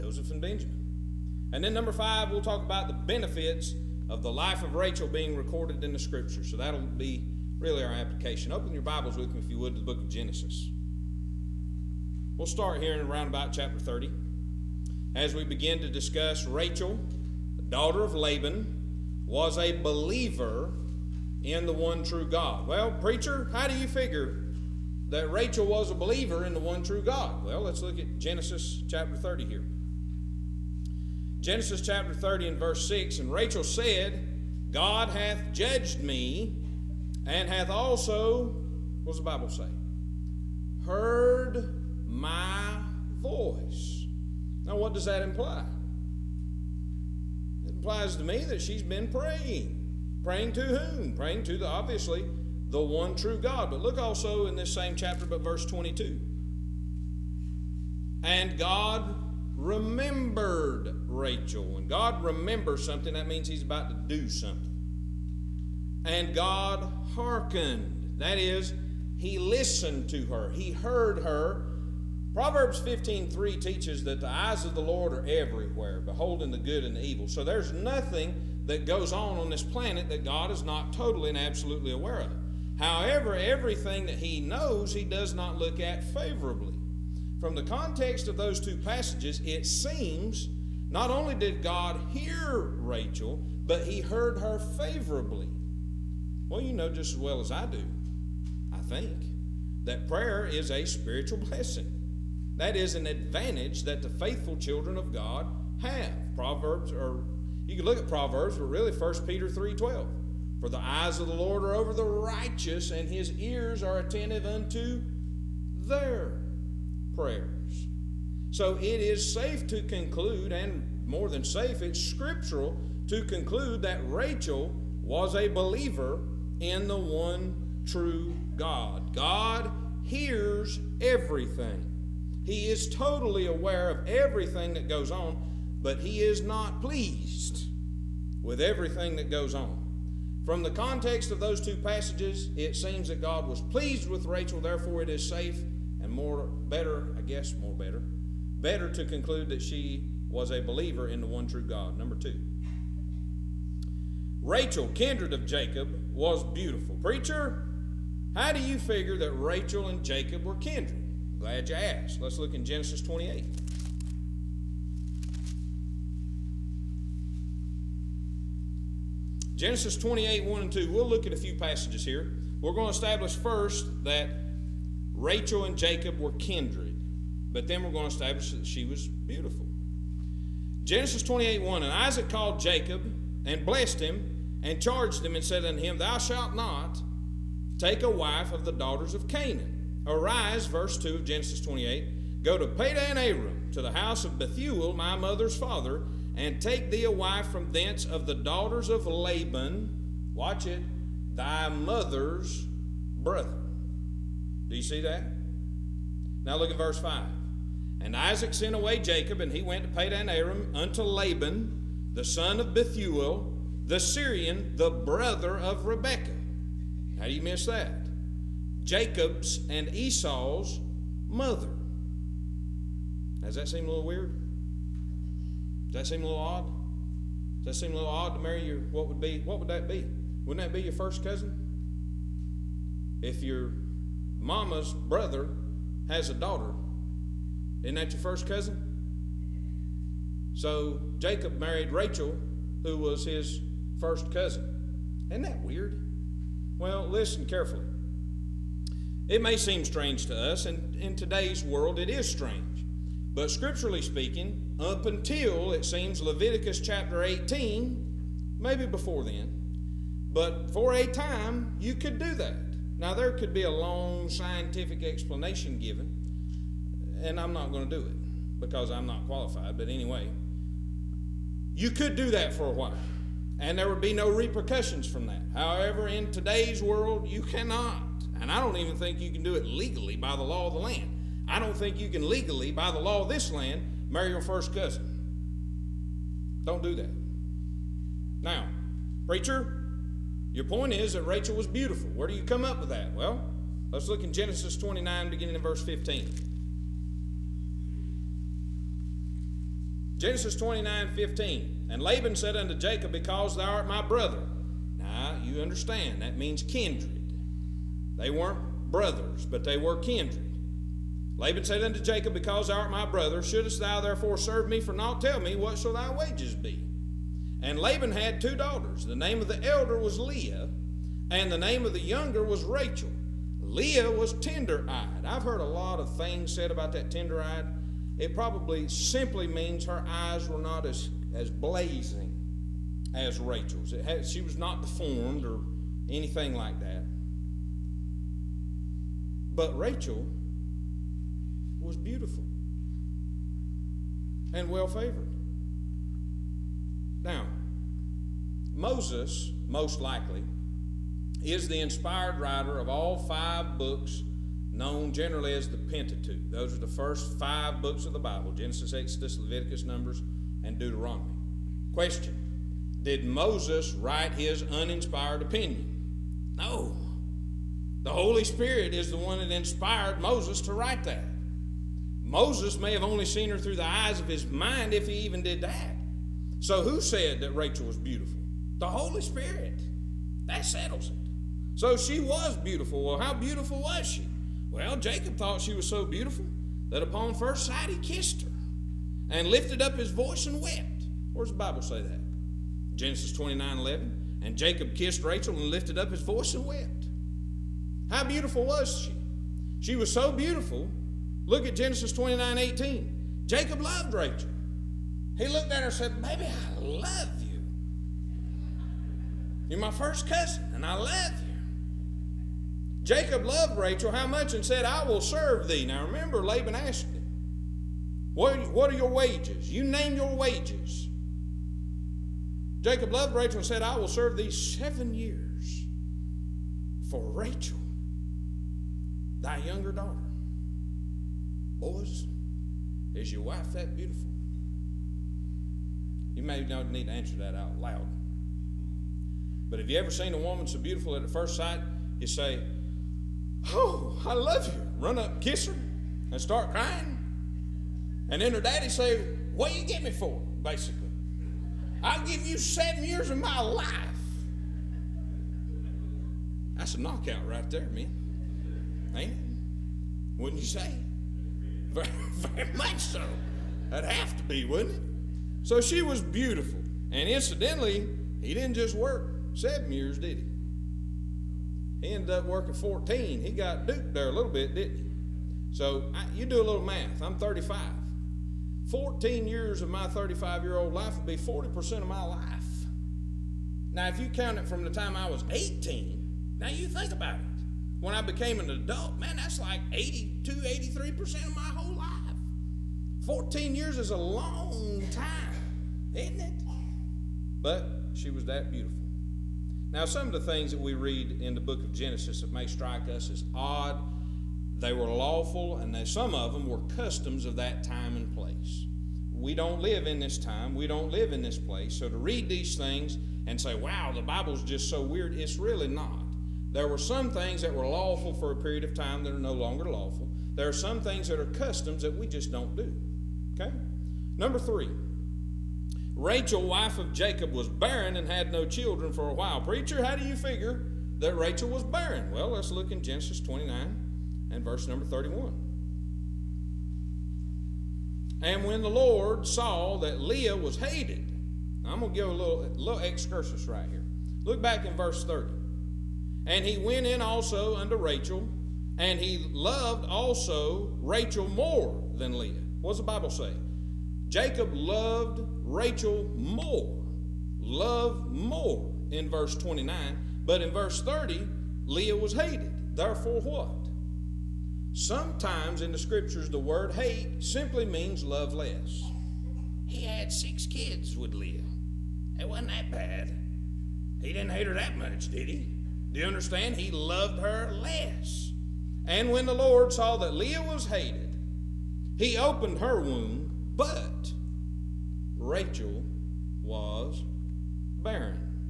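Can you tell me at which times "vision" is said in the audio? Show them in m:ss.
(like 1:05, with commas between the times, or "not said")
not said.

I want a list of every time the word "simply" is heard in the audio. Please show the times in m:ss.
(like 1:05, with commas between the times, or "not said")
5:28, 9:27.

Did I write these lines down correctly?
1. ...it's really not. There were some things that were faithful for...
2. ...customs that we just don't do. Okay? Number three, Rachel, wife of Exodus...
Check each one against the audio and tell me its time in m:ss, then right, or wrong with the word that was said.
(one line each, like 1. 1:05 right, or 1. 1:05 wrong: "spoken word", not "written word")
1. 8:35 wrong: "lawful", not "faithful"
2. 8:41 wrong: "Jacob", not "Exodus".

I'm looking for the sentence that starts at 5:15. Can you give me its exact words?
Tell me, what shall thy wages be?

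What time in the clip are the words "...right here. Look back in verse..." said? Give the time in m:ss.
9:03.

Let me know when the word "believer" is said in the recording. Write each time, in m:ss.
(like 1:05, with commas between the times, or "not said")
0:19, 0:25, 2:05, 2:30.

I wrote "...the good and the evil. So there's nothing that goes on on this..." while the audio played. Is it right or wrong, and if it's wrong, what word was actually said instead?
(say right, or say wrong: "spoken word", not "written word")
right.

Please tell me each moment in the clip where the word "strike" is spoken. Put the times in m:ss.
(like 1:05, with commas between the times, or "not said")
8:22.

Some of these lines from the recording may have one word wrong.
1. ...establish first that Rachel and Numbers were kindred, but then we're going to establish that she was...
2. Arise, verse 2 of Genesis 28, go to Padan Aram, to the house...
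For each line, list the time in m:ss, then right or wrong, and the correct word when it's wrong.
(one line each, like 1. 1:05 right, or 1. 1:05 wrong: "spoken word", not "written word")
1. 2:52 wrong: "Jacob", not "Numbers"
2. 3:10 right.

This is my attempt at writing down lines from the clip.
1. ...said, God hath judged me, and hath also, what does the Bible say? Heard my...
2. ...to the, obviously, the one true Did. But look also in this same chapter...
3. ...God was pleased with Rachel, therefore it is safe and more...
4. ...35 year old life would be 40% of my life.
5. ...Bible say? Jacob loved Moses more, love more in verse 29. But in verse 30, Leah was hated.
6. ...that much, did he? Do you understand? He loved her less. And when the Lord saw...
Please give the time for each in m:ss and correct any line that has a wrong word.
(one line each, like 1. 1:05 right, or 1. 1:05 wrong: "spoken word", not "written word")
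1. 0:33 right
2. 0:51 wrong: "God", not "Did"
3. 2:23 right
4. 8:00 right
5. 9:13 wrong: "Rachel", not "Moses"
6. 9:34 right.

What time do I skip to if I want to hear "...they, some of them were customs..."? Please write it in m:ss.
8:25.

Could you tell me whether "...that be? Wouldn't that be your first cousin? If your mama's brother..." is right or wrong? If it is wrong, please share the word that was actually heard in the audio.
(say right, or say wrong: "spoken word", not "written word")
right.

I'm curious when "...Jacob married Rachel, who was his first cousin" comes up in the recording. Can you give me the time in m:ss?
4:01.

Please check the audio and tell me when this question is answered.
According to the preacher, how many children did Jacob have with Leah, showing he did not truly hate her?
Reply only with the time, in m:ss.
9:30.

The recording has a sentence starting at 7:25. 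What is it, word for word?
Run up, kiss her, and start crying.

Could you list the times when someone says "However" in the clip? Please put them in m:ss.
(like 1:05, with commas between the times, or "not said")
1:22, 4:35.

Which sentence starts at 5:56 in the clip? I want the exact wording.
Those are the first five books of the Bible Genesis, Exodus, Leviticus, Numbers, and Deuteronomy.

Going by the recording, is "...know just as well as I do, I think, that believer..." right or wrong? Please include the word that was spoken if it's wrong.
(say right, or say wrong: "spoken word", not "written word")
wrong: "prayer", not "believer".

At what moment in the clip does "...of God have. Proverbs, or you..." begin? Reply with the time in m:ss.
1:44.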